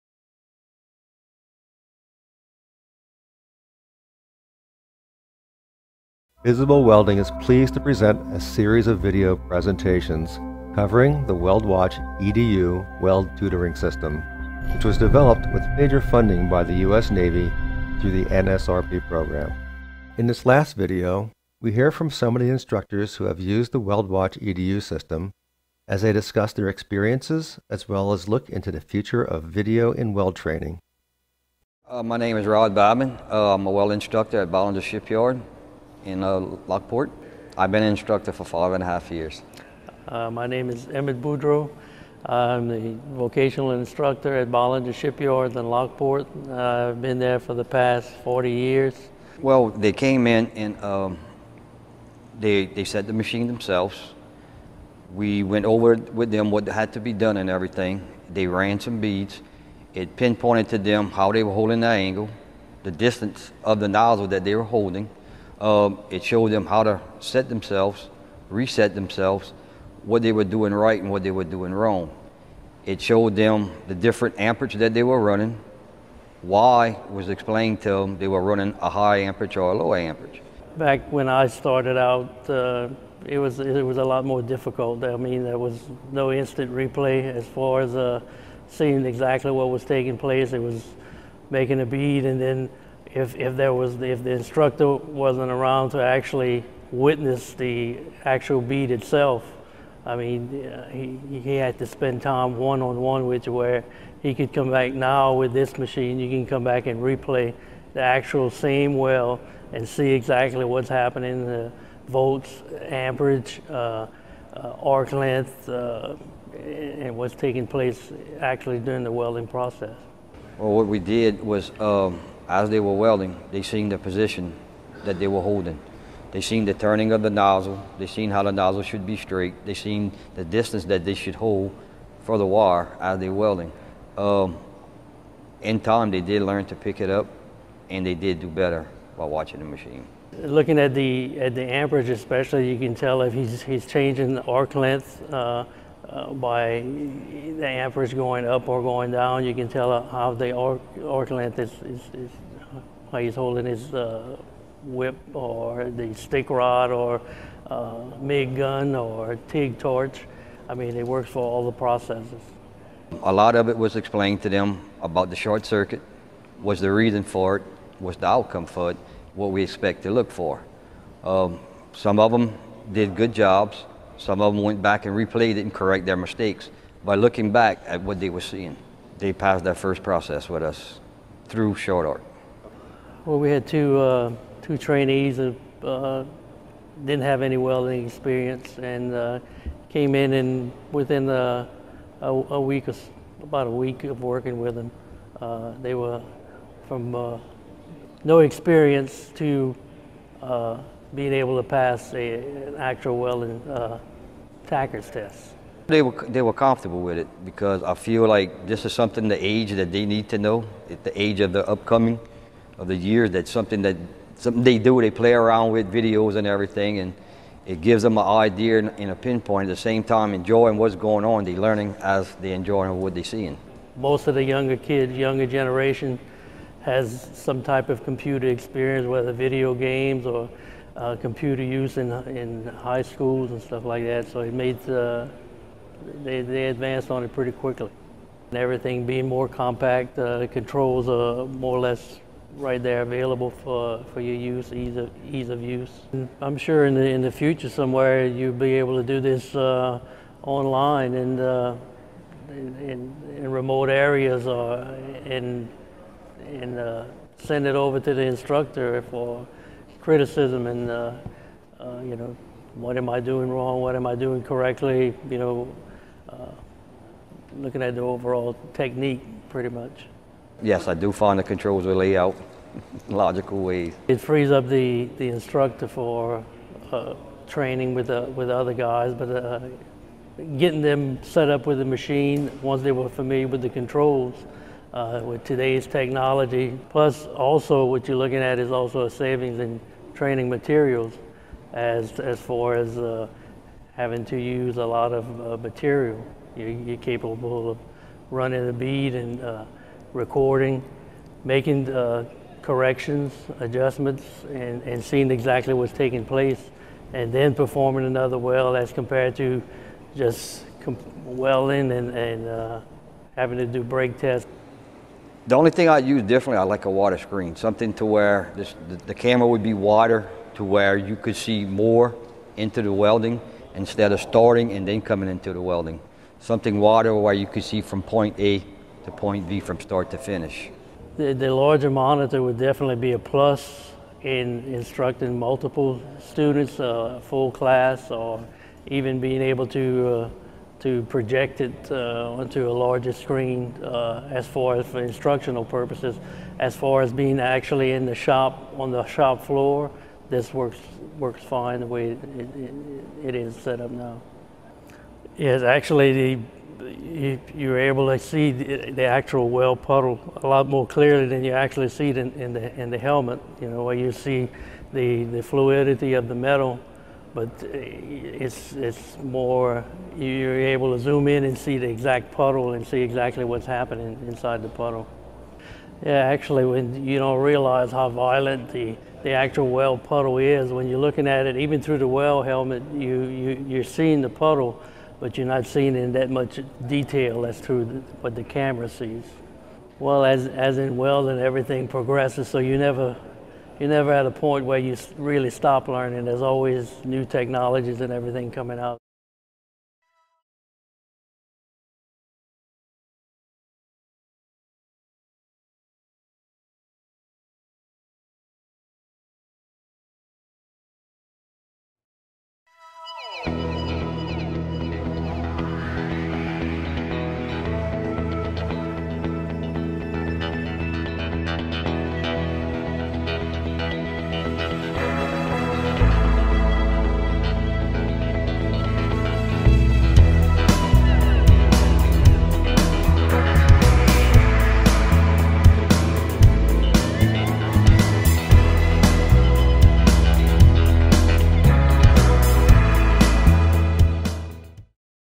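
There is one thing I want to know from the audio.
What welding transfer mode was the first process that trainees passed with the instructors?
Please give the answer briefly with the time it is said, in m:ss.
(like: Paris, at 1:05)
short arc, at 3:01.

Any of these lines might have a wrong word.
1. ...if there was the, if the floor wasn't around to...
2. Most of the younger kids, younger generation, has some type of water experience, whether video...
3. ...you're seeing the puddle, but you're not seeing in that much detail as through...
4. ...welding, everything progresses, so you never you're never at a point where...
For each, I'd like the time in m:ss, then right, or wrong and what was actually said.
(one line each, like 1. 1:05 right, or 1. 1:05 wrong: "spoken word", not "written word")
1. 1:33 wrong: "instructor", not "floor"
2. 3:43 wrong: "computer", not "water"
3. 6:23 right
4. 6:30 right.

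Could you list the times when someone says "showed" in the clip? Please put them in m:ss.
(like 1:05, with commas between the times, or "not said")
1:06, 1:12.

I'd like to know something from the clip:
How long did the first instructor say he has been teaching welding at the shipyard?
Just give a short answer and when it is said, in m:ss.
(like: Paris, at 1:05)
five and a half years, at 0:38.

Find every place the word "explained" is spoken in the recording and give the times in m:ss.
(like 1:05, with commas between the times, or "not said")
1:17, 2:43.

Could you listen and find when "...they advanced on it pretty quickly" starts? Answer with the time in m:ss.
3:56.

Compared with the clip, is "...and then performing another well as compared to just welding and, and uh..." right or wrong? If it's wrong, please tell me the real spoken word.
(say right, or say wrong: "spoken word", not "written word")
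right.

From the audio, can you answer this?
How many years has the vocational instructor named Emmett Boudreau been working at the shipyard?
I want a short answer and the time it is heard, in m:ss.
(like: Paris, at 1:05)
40 years, at 0:48.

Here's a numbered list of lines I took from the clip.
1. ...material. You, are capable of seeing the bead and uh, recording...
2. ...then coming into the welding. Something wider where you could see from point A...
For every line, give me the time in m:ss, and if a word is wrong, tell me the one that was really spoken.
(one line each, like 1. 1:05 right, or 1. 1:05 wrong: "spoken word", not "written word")
1. 4:55 wrong: "running", not "seeing"
2. 5:24 right.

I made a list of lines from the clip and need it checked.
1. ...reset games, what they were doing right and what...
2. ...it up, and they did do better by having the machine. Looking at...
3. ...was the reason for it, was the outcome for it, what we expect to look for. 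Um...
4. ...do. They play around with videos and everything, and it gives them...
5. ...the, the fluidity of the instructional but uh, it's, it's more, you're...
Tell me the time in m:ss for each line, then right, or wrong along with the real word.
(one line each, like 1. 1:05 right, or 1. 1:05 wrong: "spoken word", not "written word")
1. 1:08 wrong: "themselves", not "games"
2. 2:16 wrong: "watching", not "having"
3. 2:46 right
4. 3:34 right
5. 6:04 wrong: "metal", not "instructional".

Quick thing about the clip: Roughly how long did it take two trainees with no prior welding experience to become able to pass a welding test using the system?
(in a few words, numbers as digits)
about a week.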